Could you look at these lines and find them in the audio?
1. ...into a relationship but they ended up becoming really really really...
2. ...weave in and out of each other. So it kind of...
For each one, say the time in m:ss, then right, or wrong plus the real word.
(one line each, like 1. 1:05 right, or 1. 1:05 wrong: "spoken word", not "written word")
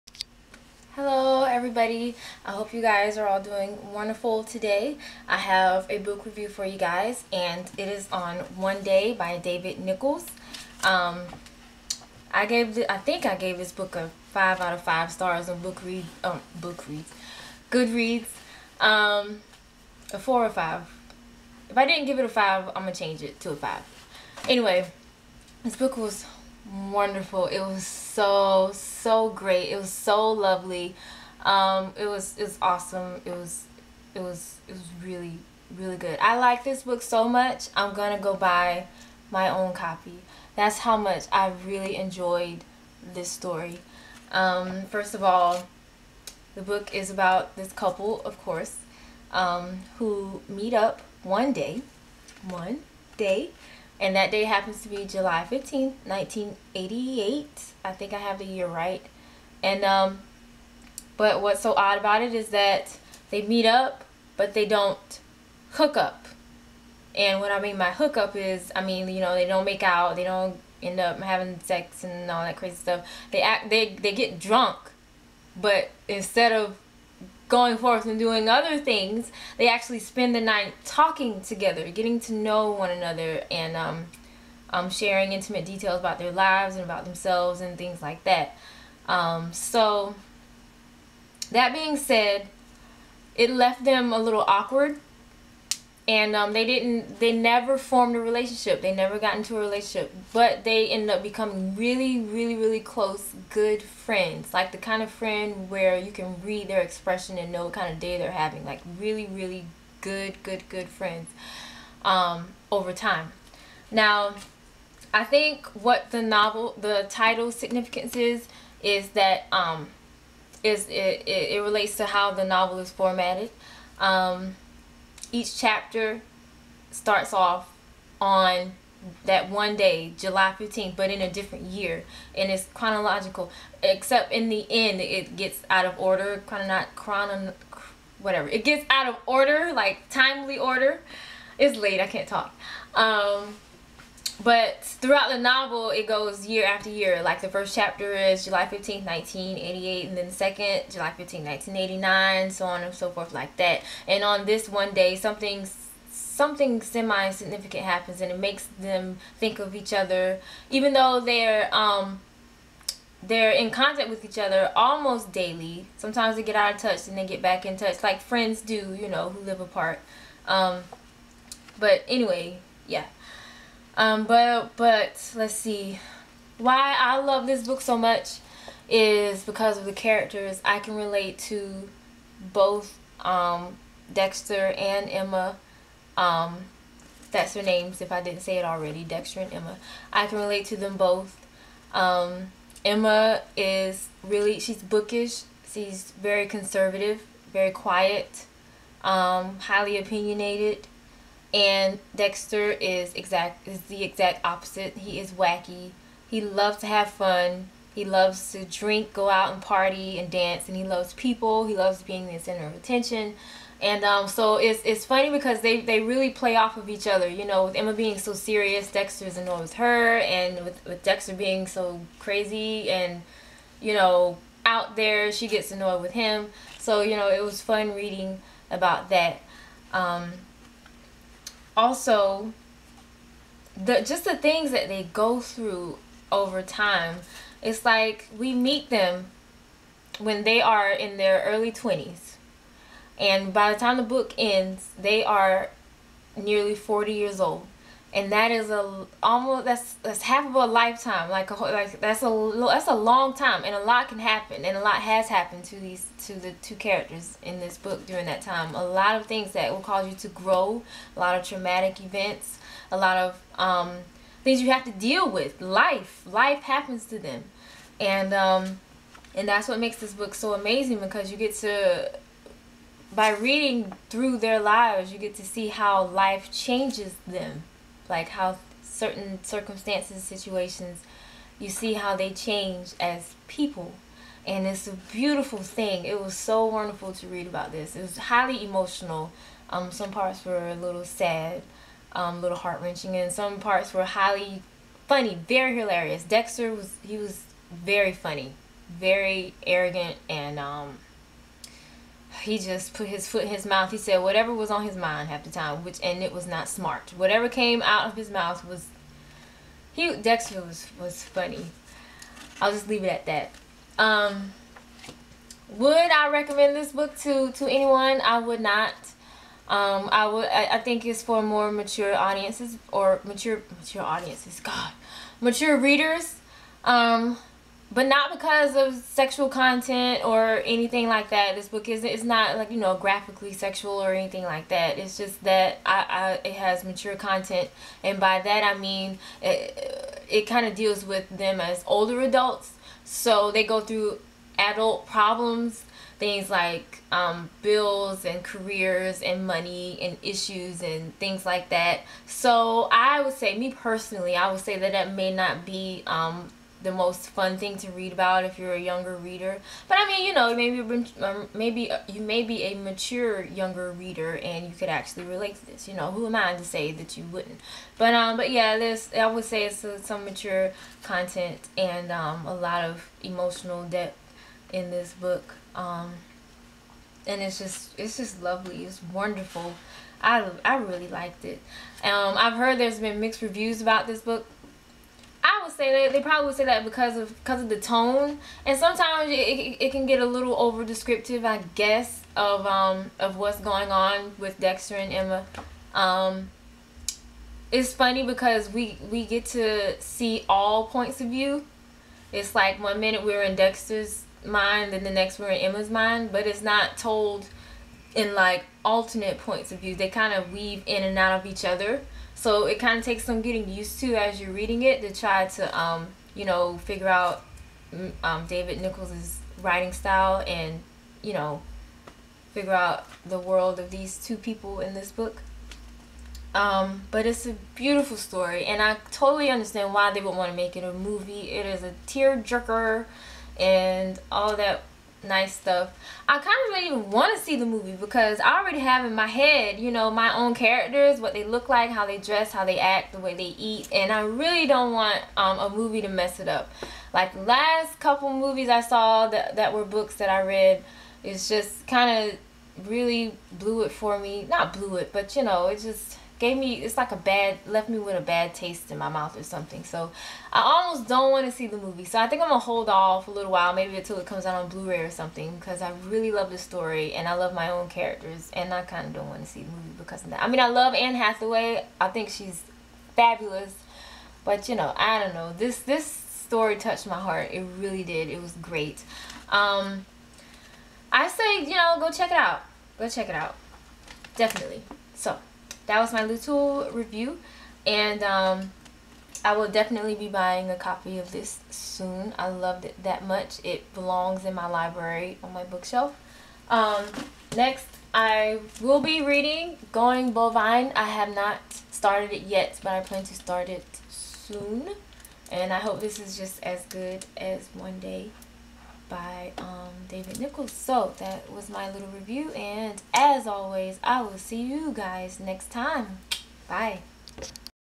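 1. 1:39 right
2. 6:50 right.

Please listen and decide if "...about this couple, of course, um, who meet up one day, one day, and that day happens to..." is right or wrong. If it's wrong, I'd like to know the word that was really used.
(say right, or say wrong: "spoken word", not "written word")
right.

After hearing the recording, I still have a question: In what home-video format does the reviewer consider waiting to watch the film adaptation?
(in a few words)
Blu-ray.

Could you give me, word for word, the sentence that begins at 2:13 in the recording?
Except in the end, it gets out of order, kind of not chrono, whatever.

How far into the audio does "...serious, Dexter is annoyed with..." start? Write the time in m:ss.
3:38.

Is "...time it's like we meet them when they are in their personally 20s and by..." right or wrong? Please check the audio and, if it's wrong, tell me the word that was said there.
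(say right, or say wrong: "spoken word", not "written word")
wrong: "early", not "personally".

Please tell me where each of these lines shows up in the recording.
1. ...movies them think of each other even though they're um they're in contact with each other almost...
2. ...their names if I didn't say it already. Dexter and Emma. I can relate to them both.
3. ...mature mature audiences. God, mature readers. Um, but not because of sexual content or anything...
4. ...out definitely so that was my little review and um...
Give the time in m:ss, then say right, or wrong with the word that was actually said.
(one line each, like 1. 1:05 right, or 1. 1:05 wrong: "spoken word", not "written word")
1. 2:38 wrong: "makes", not "movies"
2. 3:07 right
3. 5:23 right
4. 8:03 right.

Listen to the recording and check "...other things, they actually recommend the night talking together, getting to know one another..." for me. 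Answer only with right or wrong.
wrong.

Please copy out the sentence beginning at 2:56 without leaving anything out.
Why I love this book so much is because of the characters.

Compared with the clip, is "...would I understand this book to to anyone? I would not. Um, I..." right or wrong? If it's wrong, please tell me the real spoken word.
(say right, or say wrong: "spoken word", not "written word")
wrong: "recommend", not "understand".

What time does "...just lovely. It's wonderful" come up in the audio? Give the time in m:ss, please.
6:18.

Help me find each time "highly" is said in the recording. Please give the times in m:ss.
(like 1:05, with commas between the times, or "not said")
3:19, 4:48, 4:54.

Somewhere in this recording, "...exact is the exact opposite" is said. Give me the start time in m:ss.
3:23.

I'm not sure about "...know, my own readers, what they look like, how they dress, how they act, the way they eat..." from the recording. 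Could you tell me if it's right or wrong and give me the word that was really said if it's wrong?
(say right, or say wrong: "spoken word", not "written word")
wrong: "characters", not "readers".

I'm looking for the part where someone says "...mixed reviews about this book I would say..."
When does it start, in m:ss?
6:23.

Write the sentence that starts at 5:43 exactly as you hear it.
So they go through adult problems, things like um, bills and careers and money and issues and things like that.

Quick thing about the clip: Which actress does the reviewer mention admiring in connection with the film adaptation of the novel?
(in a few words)
Anne Hathaway.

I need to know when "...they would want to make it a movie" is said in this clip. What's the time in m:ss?
7:10.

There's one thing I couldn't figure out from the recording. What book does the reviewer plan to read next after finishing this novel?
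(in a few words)
Going Bovine.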